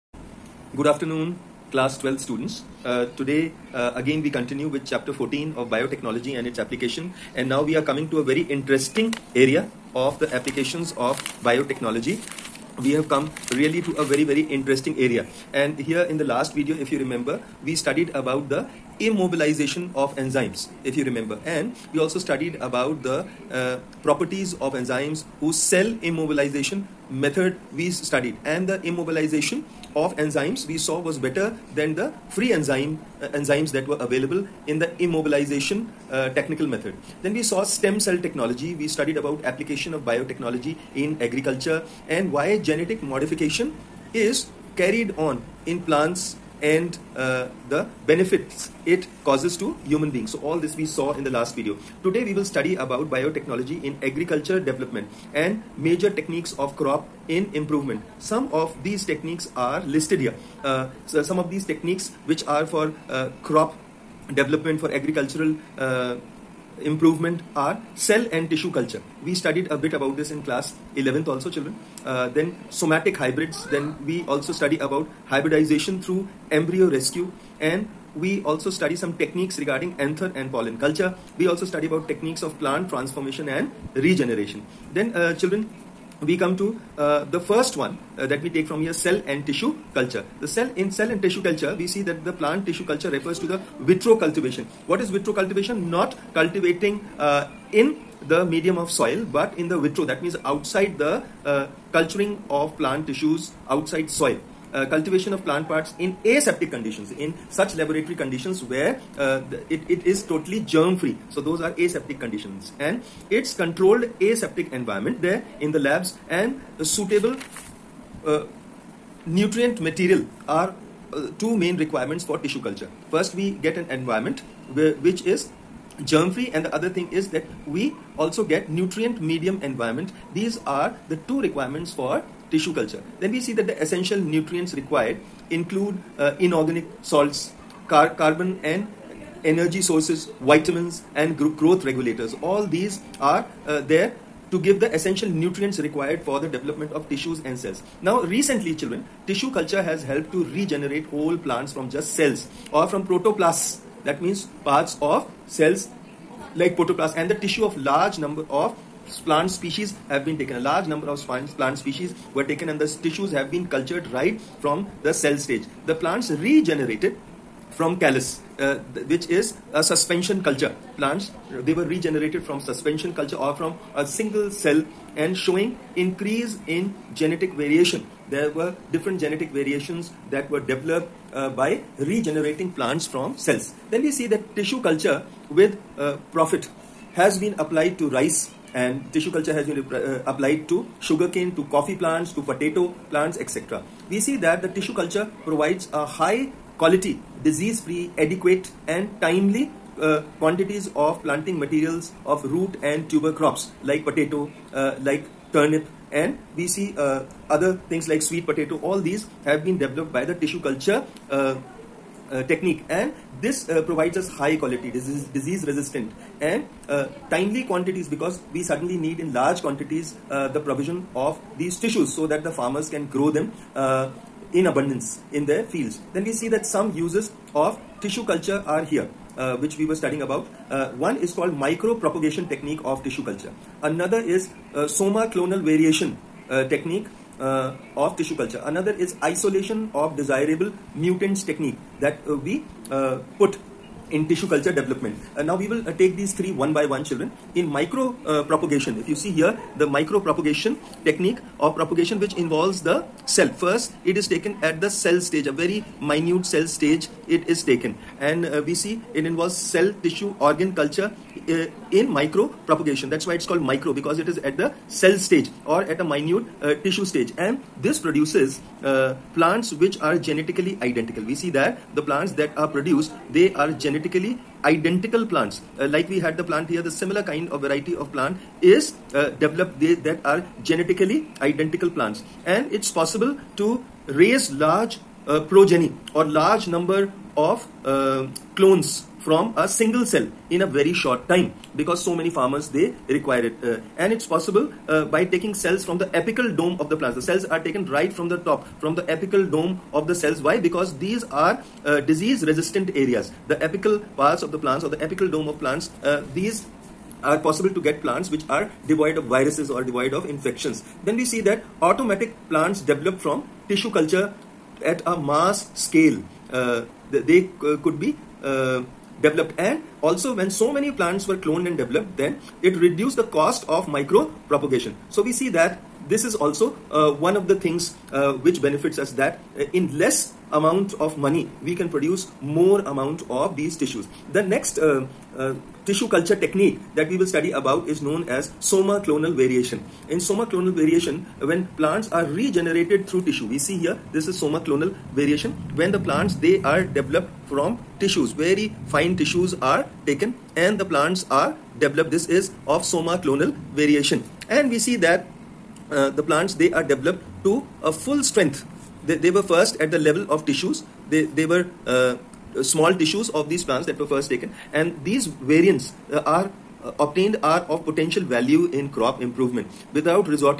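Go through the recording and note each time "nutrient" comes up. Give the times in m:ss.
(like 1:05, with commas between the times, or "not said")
1:59, 2:08, 2:14, 2:25.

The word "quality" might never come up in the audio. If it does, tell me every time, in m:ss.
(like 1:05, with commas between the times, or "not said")
3:16, 3:34.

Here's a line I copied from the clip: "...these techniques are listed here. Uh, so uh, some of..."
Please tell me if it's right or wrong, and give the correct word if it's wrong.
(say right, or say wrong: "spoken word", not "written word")
right.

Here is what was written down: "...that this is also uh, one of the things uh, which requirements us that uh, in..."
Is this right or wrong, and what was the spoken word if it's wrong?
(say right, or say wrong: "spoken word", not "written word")
wrong: "benefits", not "requirements".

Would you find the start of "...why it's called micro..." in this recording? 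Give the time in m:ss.
4:23.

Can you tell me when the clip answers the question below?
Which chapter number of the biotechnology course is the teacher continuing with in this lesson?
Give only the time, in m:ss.
0:04.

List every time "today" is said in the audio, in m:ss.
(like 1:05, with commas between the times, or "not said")
0:03, 0:52.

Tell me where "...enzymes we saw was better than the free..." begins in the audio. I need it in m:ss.
0:30.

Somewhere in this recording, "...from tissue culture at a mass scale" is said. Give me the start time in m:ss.
5:13.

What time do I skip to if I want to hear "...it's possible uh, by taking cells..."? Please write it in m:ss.
4:54.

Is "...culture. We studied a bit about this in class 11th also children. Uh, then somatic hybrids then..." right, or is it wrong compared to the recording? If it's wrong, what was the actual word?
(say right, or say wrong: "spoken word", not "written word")
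right.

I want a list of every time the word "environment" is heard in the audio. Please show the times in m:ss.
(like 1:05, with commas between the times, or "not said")
1:54, 2:03, 2:09.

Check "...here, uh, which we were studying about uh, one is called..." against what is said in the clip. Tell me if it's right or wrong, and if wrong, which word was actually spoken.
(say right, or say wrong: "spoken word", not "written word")
right.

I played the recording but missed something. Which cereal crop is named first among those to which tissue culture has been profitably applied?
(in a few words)
Rice.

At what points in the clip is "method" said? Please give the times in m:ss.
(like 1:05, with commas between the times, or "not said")
0:27, 0:36.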